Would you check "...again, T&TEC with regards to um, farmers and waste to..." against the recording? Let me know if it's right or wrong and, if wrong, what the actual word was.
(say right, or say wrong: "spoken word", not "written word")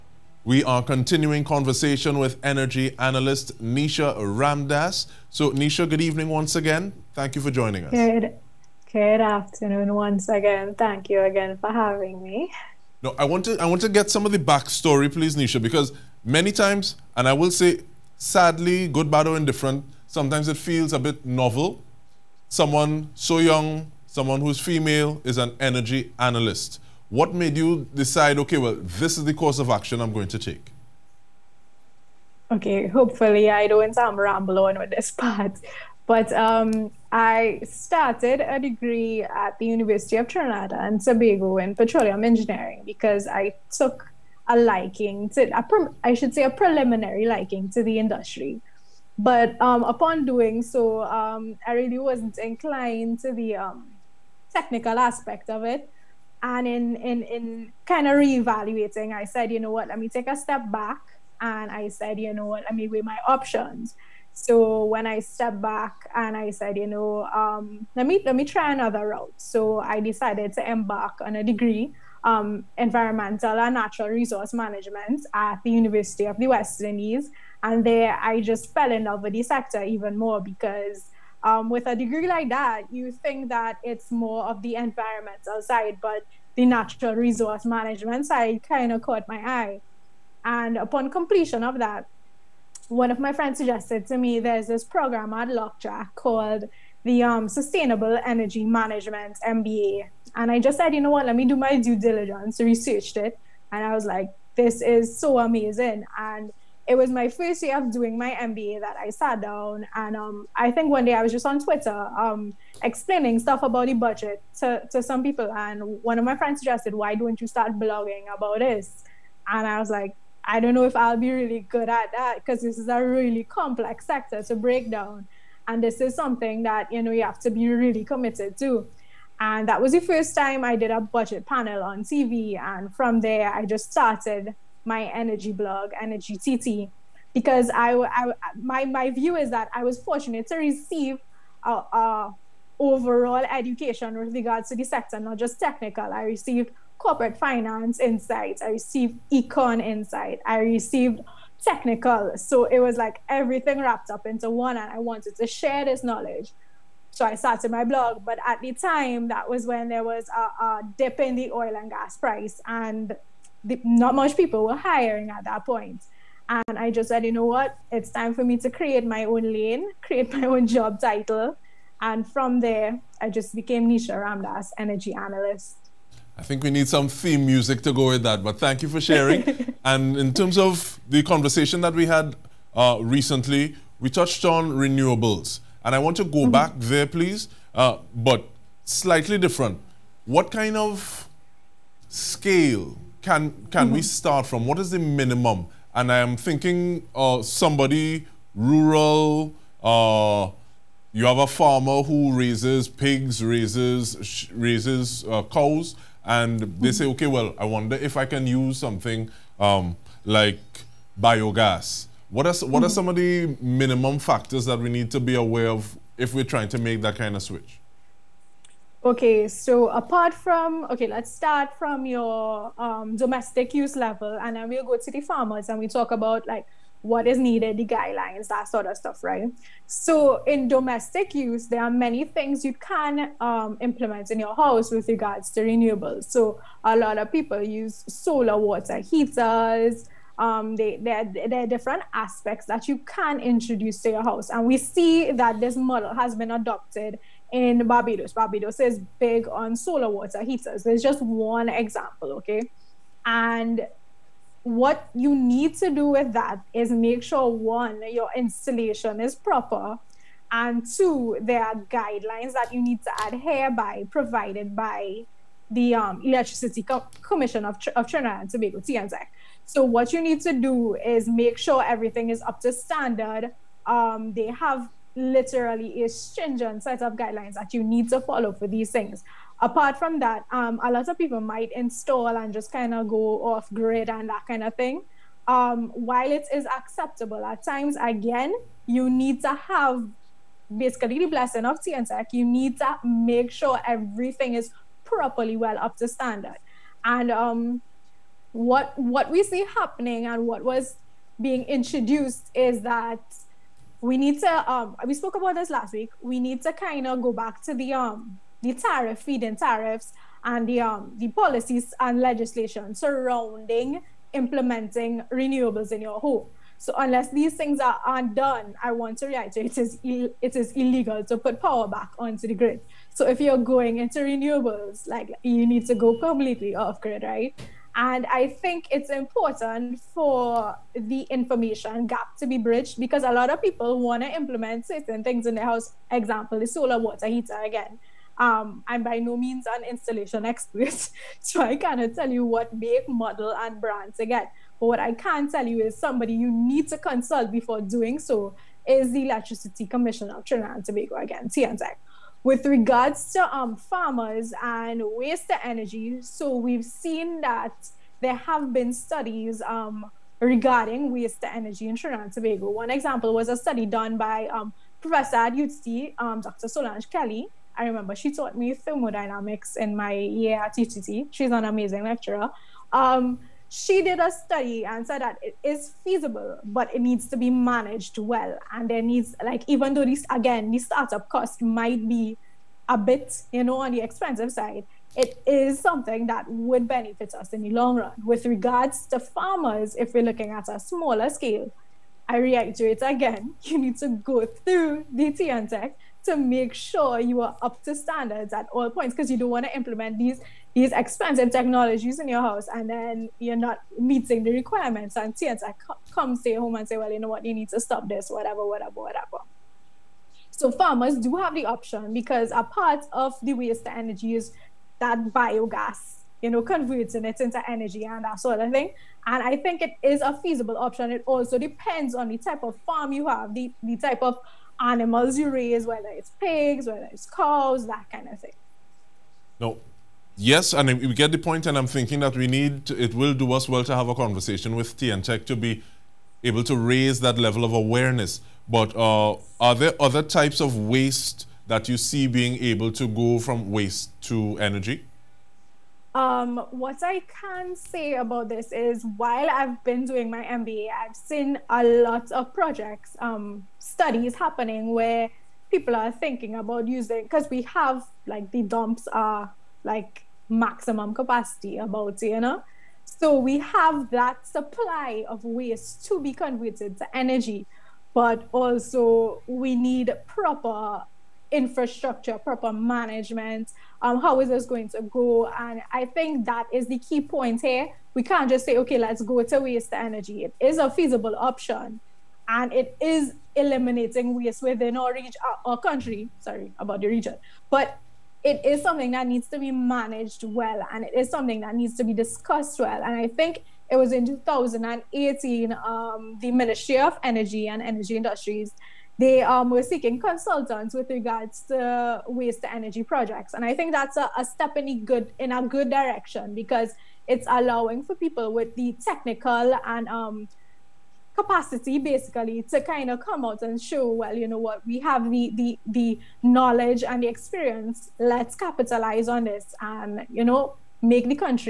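right.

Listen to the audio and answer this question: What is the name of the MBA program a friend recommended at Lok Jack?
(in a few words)
Sustainable Energy Management MBA.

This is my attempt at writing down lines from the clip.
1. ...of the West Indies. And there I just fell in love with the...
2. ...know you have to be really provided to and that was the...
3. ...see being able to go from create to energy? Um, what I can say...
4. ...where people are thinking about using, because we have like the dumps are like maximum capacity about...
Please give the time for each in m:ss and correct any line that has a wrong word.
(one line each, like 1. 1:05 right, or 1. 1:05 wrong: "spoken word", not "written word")
1. 1:16 right
2. 2:07 wrong: "committed", not "provided"
3. 7:21 wrong: "waste", not "create"
4. 7:34 right.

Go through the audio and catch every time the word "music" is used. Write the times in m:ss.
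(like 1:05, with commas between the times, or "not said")
2:57.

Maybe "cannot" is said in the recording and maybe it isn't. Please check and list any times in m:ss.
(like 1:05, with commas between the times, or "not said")
5:41.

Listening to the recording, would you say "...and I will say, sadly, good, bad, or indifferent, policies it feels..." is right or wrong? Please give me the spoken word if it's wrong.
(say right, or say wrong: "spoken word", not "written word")
wrong: "sometimes", not "policies".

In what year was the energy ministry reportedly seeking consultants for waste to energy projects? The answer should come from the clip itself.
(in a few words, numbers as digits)
2018.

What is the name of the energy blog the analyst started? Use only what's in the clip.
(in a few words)
Energy TT.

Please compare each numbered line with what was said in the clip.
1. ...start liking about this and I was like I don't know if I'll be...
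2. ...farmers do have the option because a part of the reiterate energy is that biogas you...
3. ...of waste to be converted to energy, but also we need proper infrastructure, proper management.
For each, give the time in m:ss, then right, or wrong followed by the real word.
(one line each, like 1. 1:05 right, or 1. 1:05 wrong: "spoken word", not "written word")
1. 1:57 wrong: "blogging", not "liking"
2. 6:50 wrong: "waste", not "reiterate"
3. 7:45 right.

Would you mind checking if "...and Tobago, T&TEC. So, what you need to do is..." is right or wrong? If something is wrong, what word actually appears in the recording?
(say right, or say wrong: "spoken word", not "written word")
right.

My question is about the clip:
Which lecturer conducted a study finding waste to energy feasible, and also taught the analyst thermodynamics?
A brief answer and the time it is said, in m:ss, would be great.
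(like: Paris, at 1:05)
Dr. Solange Kelly, at 6:06.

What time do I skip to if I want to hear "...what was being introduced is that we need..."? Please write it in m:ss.
5:00.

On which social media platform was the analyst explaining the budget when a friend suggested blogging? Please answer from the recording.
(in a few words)
Twitter.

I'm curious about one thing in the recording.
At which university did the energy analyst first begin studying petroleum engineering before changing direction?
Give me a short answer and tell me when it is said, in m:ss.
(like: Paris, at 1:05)
University of Trinidad and Tobago, at 0:39.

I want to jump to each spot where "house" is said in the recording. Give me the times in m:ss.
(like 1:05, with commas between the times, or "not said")
3:54, 4:04, 5:35, 6:42.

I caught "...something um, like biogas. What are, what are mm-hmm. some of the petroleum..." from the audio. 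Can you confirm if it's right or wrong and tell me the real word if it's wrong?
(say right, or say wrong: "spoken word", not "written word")
wrong: "minimum", not "petroleum".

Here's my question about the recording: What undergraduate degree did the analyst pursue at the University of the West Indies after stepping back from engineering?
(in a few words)
Environmental and natural resource management.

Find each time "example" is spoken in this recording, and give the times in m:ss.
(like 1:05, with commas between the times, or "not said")
4:11, 5:36, 6:02.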